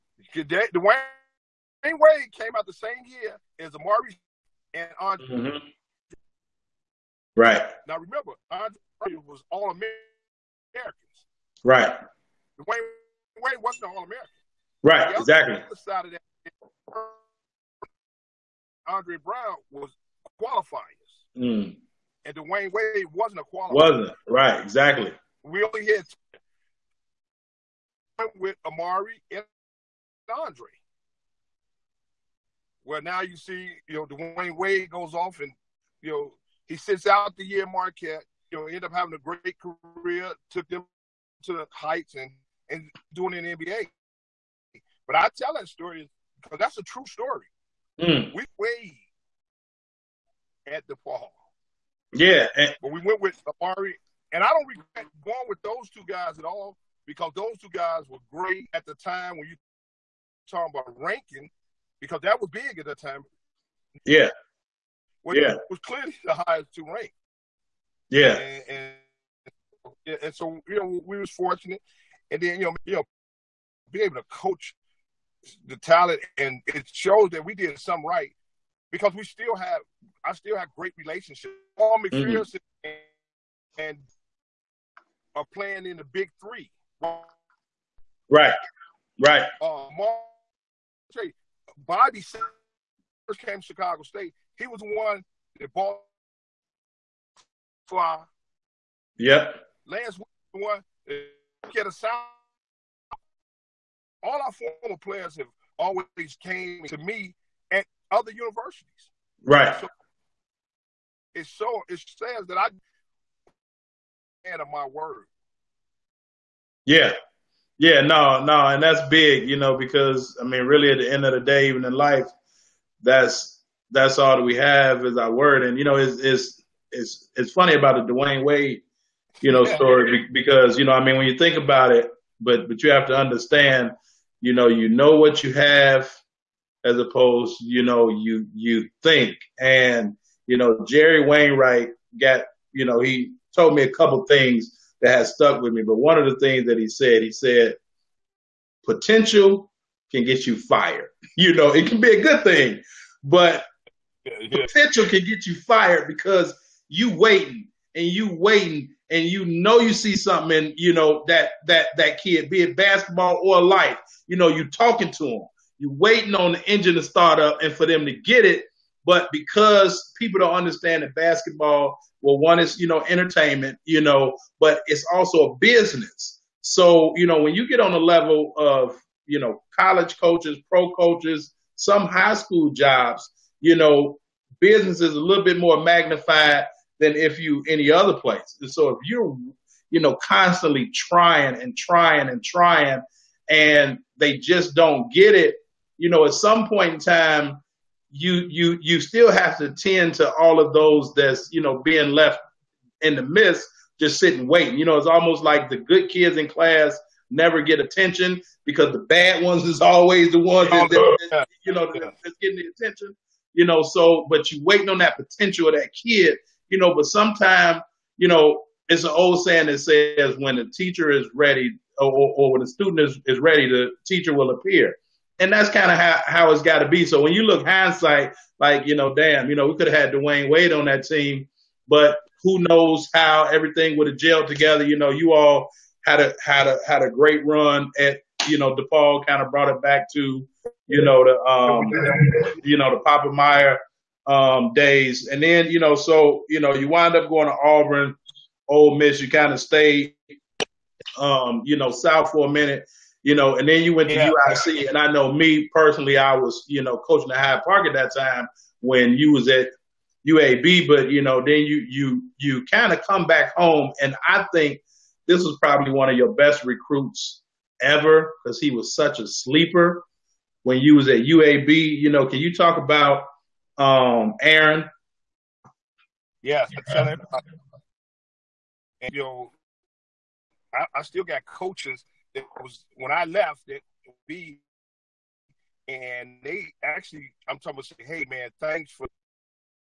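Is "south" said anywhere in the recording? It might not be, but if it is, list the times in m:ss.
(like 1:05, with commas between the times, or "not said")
4:11.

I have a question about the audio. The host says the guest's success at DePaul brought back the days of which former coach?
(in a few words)
Papa Meyer.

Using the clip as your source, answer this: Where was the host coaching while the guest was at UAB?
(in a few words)
Hyde Park.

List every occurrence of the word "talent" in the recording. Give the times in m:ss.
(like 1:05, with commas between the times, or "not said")
1:15.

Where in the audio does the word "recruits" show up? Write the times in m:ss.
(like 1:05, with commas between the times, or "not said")
4:26.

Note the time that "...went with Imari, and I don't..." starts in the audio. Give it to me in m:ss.
0:53.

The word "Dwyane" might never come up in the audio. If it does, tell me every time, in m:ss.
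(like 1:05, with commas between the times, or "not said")
0:00, 0:12, 0:22, 0:34, 2:08, 3:50.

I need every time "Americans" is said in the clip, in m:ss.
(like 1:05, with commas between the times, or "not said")
0:09, 0:14.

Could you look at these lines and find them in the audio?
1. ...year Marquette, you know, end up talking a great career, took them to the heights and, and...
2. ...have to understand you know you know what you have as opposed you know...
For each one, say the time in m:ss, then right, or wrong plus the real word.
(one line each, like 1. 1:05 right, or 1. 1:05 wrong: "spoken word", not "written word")
1. 0:37 wrong: "having", not "talking"
2. 2:12 right.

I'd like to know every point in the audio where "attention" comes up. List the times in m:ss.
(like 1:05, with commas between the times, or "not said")
3:27, 3:32.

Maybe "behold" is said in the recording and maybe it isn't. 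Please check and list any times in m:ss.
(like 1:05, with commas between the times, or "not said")
not said.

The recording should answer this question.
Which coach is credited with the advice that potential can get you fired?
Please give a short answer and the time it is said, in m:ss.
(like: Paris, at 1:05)
Jerry Wainwright, at 2:20.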